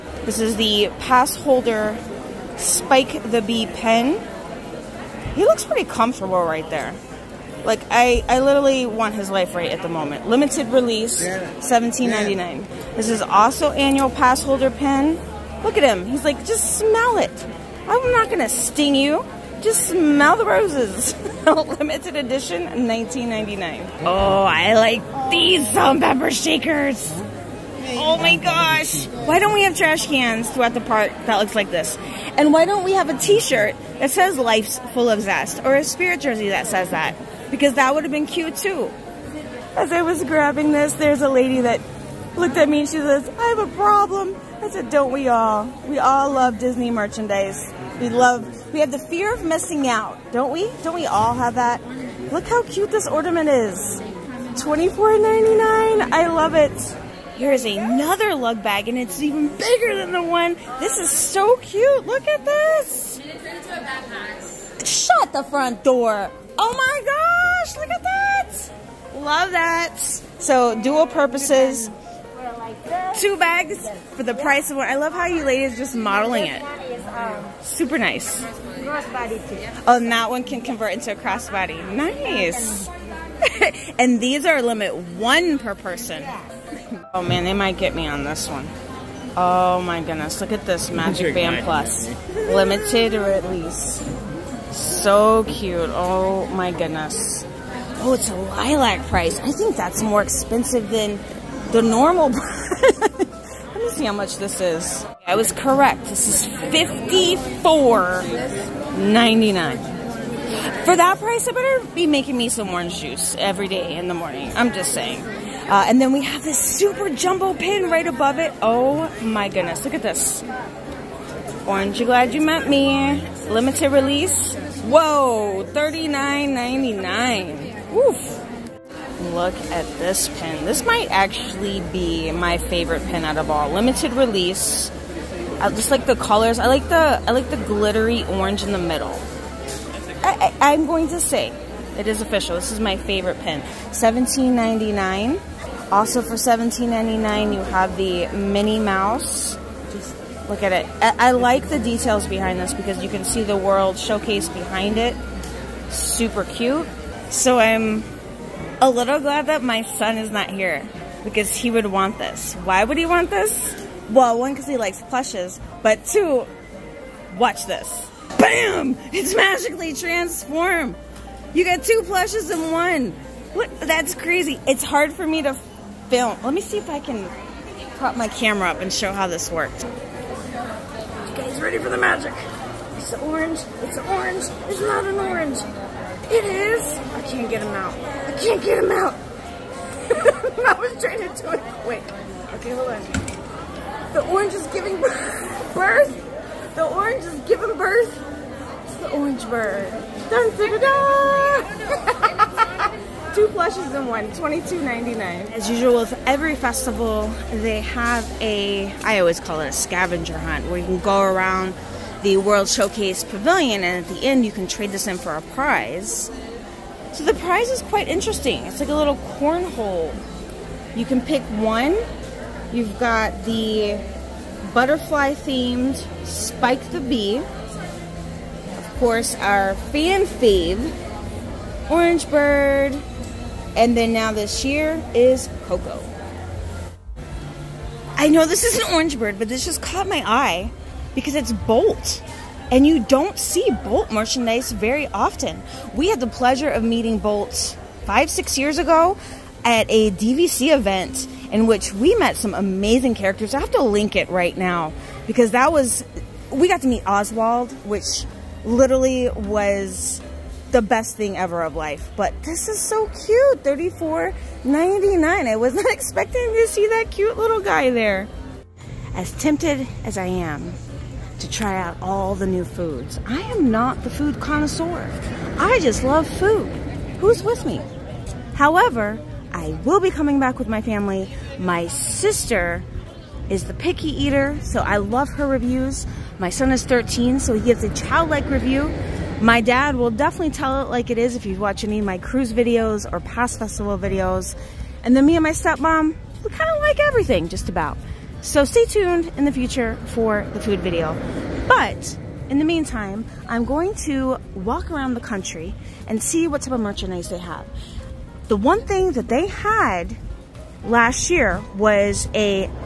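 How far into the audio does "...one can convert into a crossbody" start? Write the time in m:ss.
1:20.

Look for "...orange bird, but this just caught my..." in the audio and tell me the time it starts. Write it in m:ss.
3:58.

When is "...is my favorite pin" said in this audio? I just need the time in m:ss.
2:22.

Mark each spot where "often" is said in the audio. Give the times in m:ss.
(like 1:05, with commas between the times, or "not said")
4:05.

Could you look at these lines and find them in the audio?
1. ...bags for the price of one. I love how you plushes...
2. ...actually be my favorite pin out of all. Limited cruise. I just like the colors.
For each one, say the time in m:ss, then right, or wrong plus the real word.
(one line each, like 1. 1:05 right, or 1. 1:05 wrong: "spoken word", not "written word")
1. 1:13 wrong: "ladies", not "plushes"
2. 2:11 wrong: "release", not "cruise".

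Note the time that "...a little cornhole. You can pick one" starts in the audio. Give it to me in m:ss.
3:38.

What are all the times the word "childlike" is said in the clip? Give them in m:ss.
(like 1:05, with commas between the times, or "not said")
4:47.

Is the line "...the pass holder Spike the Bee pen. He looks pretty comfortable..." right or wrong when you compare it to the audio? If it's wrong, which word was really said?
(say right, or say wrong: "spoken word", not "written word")
right.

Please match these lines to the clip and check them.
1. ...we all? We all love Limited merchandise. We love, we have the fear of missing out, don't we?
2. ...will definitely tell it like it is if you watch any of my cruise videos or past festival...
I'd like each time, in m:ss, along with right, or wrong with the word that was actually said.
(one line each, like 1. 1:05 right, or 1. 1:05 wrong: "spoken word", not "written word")
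1. 0:45 wrong: "Disney", not "Limited"
2. 4:49 right.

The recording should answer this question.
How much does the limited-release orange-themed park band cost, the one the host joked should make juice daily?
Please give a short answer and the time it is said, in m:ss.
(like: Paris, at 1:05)
$54.99, at 1:46.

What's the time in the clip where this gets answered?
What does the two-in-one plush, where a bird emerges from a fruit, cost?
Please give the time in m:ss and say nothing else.
3:24.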